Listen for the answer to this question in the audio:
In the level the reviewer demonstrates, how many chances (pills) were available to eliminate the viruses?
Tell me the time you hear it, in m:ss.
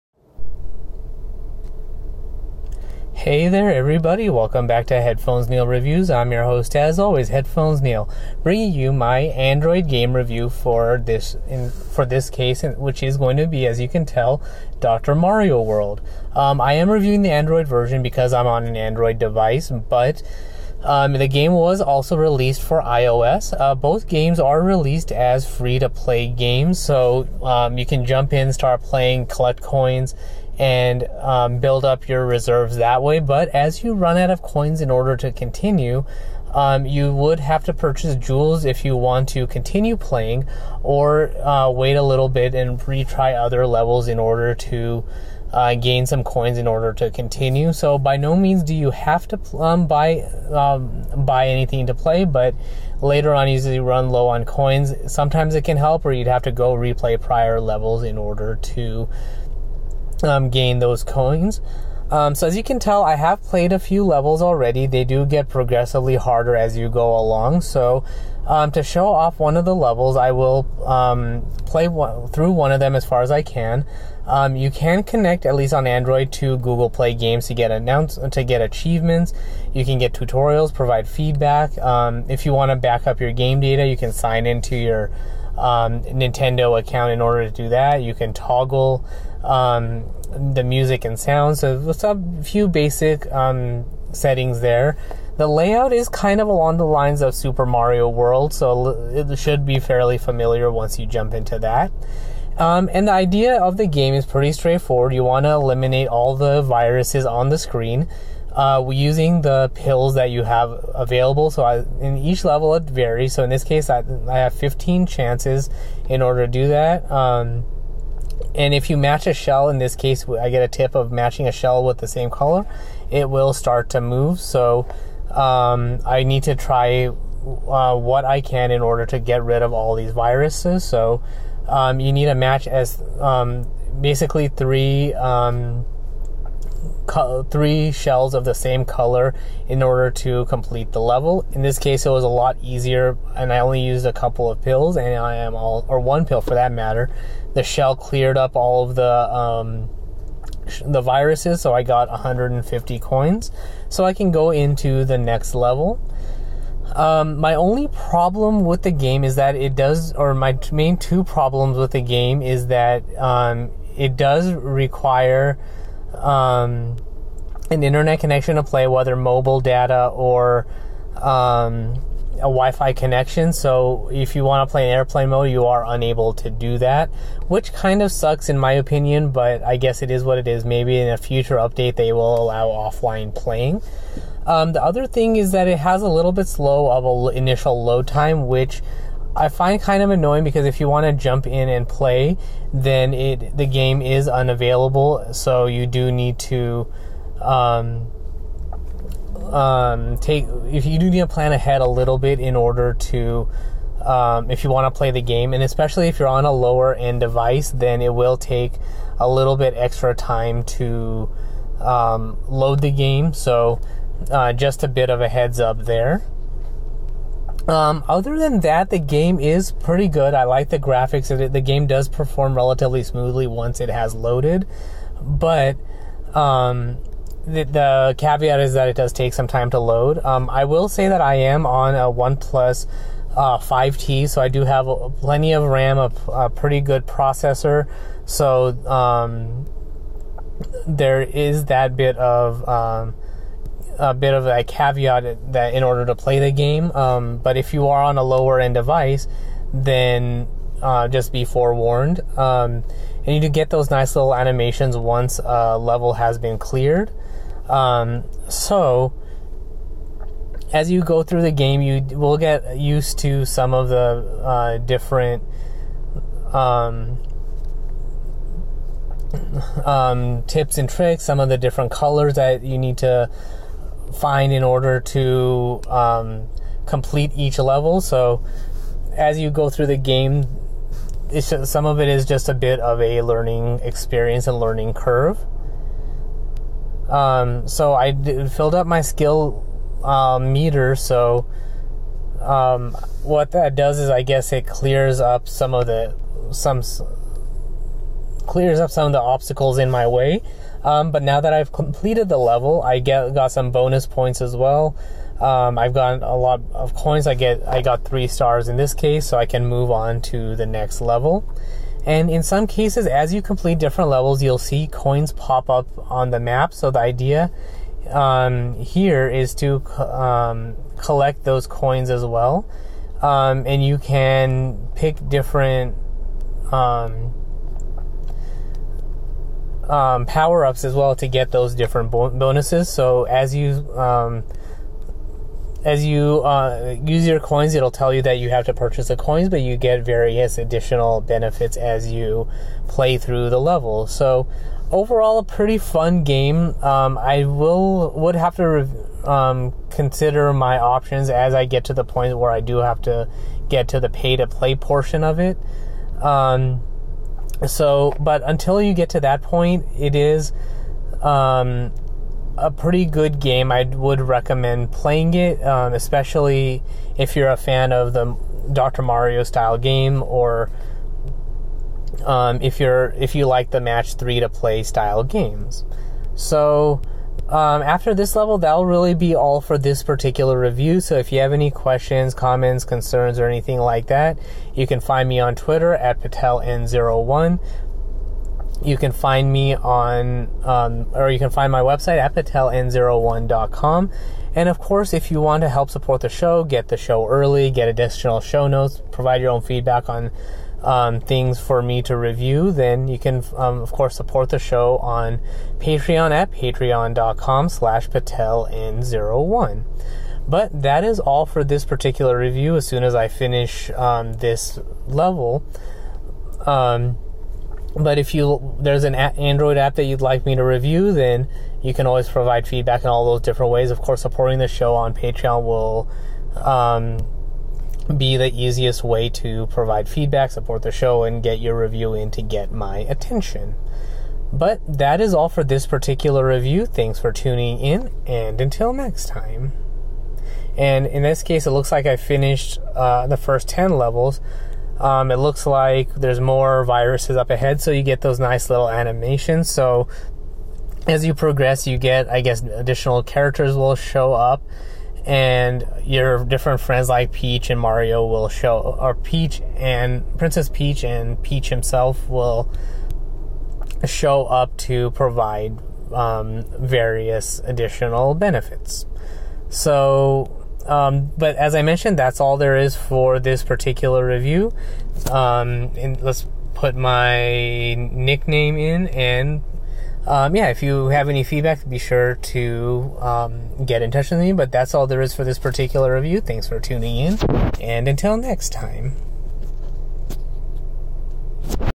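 1:54.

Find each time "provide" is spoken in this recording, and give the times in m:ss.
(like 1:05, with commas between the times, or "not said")
1:20, 6:39, 7:02, 7:09, 7:45.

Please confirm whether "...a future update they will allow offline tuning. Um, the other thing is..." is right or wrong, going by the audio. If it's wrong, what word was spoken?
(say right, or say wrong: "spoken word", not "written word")
wrong: "playing", not "tuning".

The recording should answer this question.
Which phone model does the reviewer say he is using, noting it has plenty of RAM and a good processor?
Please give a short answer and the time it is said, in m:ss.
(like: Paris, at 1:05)
OnePlus 5T, at 3:52.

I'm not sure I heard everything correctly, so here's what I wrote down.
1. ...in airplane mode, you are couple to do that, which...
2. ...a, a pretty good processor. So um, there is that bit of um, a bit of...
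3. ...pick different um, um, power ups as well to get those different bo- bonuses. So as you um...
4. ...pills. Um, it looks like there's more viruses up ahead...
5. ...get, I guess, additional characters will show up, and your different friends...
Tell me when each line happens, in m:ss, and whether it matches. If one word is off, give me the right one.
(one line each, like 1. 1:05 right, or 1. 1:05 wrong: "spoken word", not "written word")
1. 2:54 wrong: "unable", not "couple"
2. 3:55 right
3. 5:24 right
4. 7:23 wrong: "levels", not "pills"
5. 7:31 right.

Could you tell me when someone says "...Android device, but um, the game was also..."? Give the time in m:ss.
0:18.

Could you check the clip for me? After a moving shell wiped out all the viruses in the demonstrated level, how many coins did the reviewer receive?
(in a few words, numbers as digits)
150.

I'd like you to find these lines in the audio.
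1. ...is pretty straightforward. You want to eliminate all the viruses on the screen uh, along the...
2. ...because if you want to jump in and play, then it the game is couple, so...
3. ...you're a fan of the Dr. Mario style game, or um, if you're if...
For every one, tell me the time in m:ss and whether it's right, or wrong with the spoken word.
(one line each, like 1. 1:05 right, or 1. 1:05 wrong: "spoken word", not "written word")
1. 1:44 wrong: "using", not "along"
2. 3:10 wrong: "unavailable", not "couple"
3. 6:07 right.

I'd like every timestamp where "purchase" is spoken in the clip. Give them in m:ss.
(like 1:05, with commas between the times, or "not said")
0:37, 5:38.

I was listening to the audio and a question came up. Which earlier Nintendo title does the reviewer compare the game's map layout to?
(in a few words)
Super Mario World.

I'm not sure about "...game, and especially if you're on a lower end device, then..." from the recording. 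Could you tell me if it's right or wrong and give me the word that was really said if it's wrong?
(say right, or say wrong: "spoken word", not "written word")
right.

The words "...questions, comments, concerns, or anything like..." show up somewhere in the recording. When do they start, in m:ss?
6:21.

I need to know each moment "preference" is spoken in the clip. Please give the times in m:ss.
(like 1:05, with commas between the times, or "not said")
not said.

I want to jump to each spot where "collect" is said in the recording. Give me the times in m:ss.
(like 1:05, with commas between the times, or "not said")
0:29, 5:20.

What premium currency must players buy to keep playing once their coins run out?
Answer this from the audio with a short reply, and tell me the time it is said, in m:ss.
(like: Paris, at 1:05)
Jewels, at 0:38.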